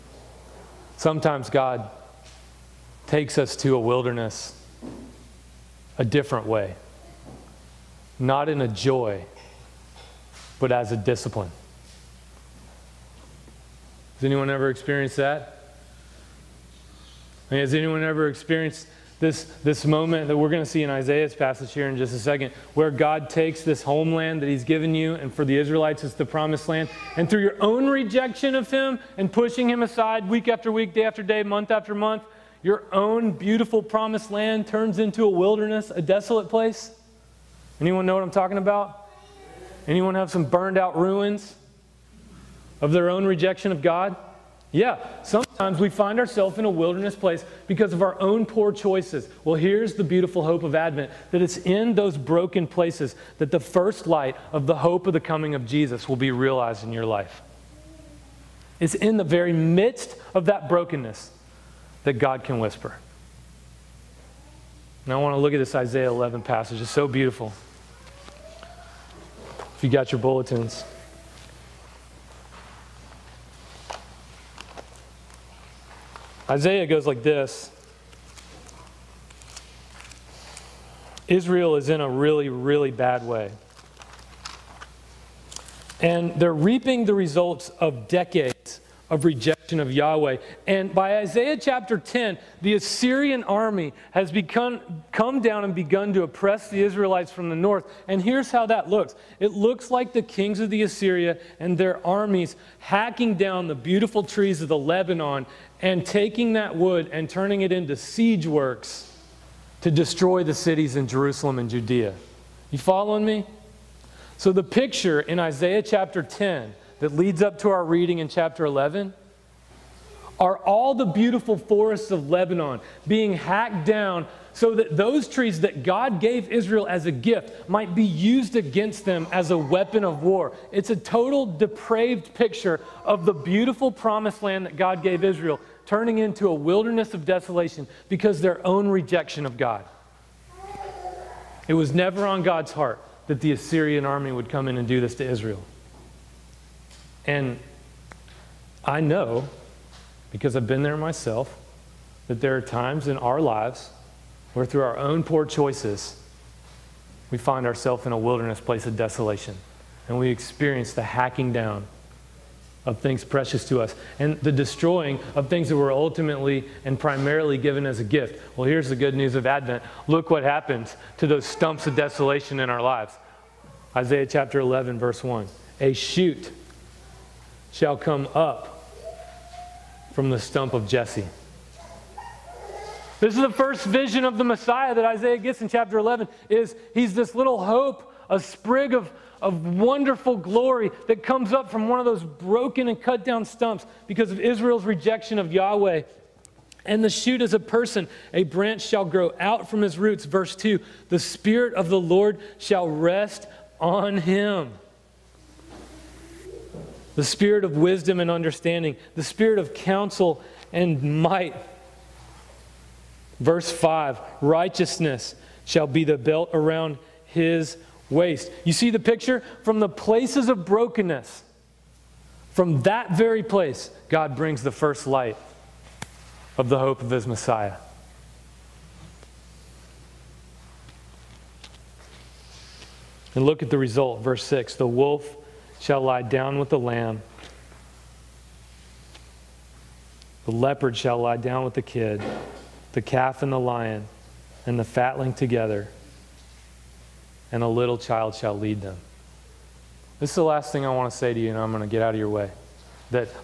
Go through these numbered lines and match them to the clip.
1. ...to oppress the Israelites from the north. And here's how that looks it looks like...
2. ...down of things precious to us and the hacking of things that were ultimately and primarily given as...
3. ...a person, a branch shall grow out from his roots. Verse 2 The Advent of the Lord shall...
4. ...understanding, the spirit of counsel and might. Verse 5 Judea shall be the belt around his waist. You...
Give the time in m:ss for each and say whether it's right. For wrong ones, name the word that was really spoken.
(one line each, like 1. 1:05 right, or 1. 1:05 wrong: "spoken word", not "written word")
1. 1:36 right
2. 2:41 wrong: "destroying", not "hacking"
3. 3:17 wrong: "Spirit", not "Advent"
4. 3:28 wrong: "Righteousness", not "Judea".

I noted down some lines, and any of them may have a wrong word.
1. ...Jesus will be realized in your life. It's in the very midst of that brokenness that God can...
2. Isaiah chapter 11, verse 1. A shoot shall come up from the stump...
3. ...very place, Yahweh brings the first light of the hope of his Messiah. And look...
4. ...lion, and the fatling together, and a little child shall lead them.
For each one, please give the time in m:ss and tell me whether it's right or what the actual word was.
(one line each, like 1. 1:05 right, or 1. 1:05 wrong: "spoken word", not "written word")
1. 0:55 right
2. 2:53 right
3. 3:43 wrong: "God", not "Yahweh"
4. 4:03 right.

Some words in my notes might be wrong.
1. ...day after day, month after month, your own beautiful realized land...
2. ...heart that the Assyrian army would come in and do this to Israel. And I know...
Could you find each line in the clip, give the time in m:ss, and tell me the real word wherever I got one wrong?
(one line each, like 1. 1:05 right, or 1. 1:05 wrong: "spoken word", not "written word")
1. 0:30 wrong: "promised", not "realized"
2. 2:22 right.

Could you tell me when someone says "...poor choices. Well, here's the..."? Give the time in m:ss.
0:48.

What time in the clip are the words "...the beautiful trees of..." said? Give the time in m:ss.
1:43.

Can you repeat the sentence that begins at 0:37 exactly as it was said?
Anyone know what I'm talking about?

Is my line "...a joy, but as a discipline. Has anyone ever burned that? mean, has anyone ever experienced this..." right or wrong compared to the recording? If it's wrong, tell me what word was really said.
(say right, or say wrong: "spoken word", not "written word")
wrong: "experienced", not "burned".